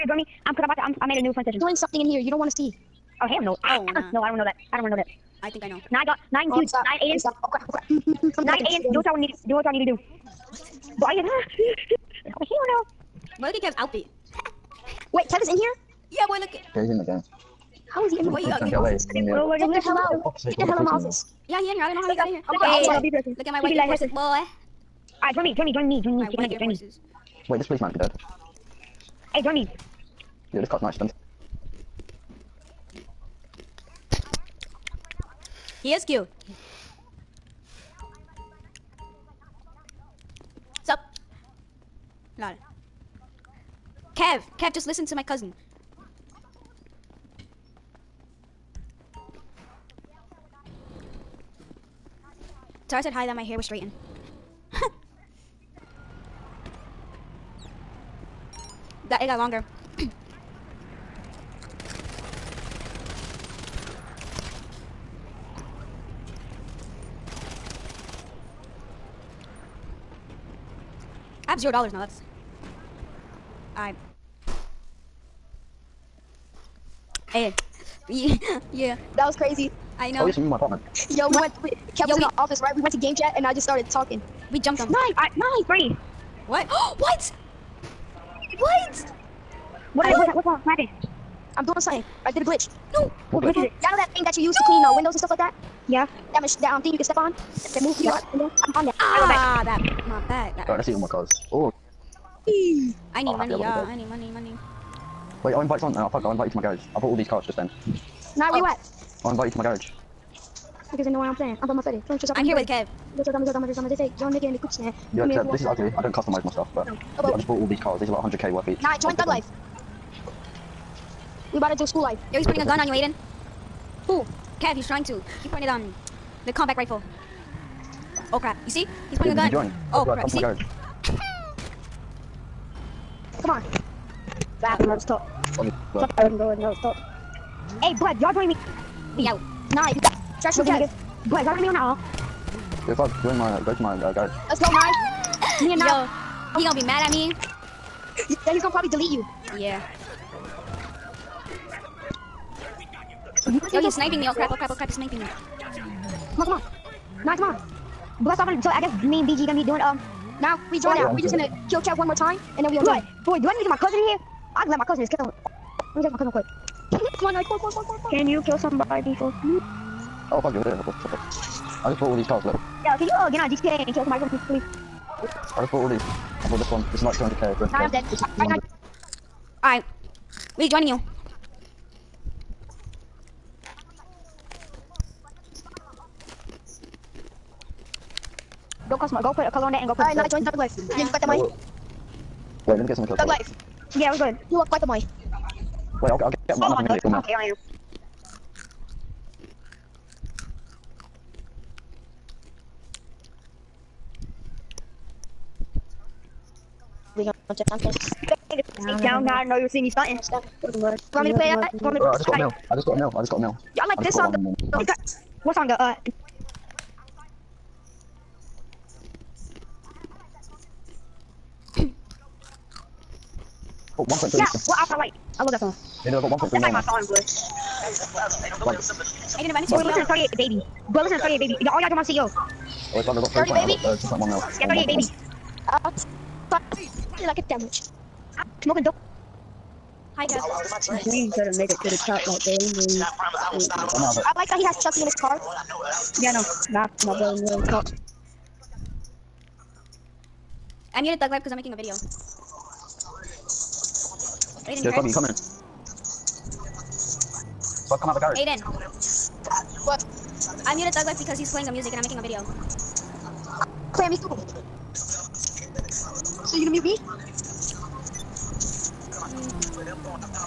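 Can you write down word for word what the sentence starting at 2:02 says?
Yo, he's putting a gun on you, Aiden.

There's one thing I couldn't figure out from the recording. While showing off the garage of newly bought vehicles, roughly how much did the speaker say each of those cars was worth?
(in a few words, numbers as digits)
100k.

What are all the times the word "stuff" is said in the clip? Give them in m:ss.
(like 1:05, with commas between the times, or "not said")
1:35, 1:56.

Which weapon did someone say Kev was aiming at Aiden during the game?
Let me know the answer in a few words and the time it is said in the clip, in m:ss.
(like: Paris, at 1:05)
combat rifle, at 2:06.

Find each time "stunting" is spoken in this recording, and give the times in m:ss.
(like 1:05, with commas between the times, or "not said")
3:29.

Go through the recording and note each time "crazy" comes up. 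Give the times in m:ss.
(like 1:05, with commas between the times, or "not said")
1:19.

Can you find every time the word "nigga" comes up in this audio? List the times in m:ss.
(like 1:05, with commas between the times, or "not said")
1:54, 2:20.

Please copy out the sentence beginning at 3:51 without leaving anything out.
Y'all, all y'all join my CEO.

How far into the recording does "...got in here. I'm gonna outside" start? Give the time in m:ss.
0:22.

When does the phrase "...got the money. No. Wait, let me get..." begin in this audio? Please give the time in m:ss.
3:11.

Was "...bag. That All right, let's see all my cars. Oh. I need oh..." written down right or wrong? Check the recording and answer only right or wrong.
right.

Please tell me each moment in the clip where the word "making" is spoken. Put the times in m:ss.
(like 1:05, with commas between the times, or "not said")
4:11, 4:22.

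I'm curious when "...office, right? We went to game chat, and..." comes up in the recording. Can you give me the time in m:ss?
1:22.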